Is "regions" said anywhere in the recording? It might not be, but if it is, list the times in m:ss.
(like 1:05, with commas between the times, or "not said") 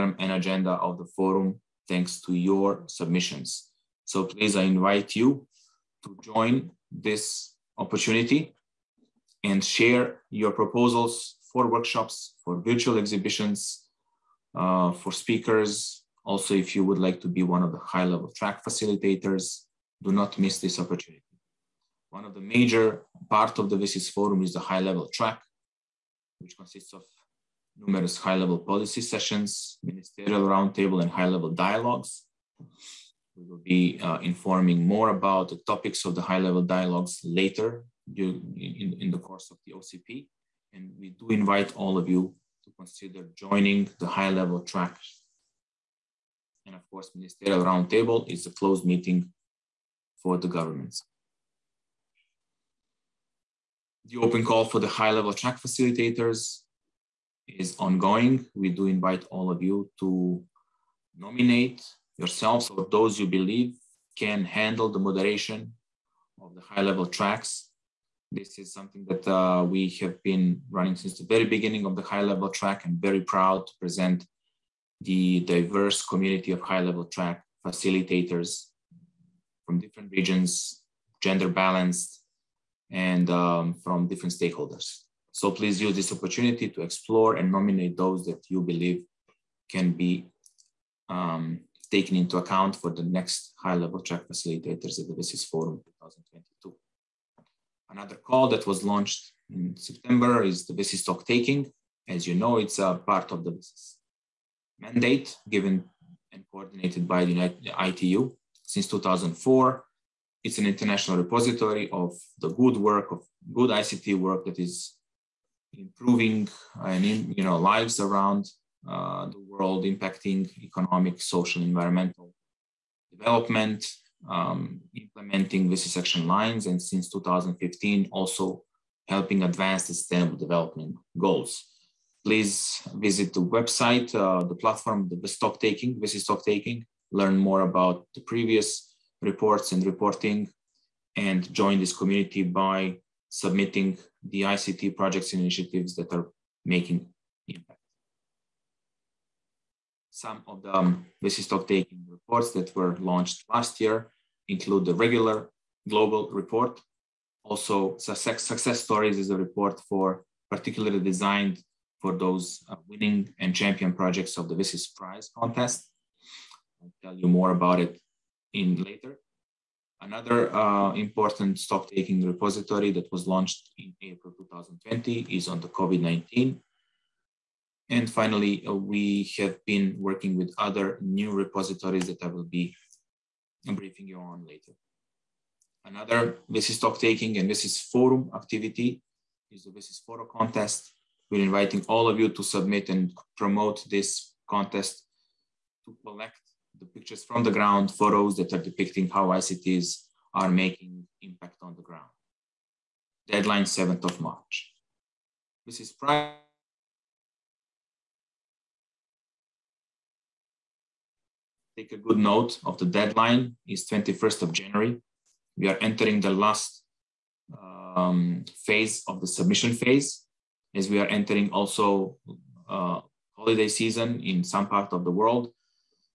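1:20.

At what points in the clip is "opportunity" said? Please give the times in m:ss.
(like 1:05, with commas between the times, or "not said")
0:07, 0:20, 1:26.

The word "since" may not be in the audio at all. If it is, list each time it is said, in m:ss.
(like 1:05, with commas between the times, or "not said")
1:10, 1:48, 2:06.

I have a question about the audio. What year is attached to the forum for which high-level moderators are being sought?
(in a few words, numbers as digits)
2022.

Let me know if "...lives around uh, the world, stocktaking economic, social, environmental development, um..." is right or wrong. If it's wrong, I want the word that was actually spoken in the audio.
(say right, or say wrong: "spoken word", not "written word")
wrong: "impacting", not "stocktaking".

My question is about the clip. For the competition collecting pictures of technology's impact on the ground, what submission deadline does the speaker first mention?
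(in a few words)
7th of March.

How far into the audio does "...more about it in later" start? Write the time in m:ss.
2:47.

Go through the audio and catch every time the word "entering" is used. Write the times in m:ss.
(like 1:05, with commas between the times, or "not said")
3:35, 3:41.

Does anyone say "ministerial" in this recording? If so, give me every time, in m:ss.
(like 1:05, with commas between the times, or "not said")
0:29, 0:47.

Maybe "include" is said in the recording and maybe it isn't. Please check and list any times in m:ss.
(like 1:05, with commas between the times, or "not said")
2:34.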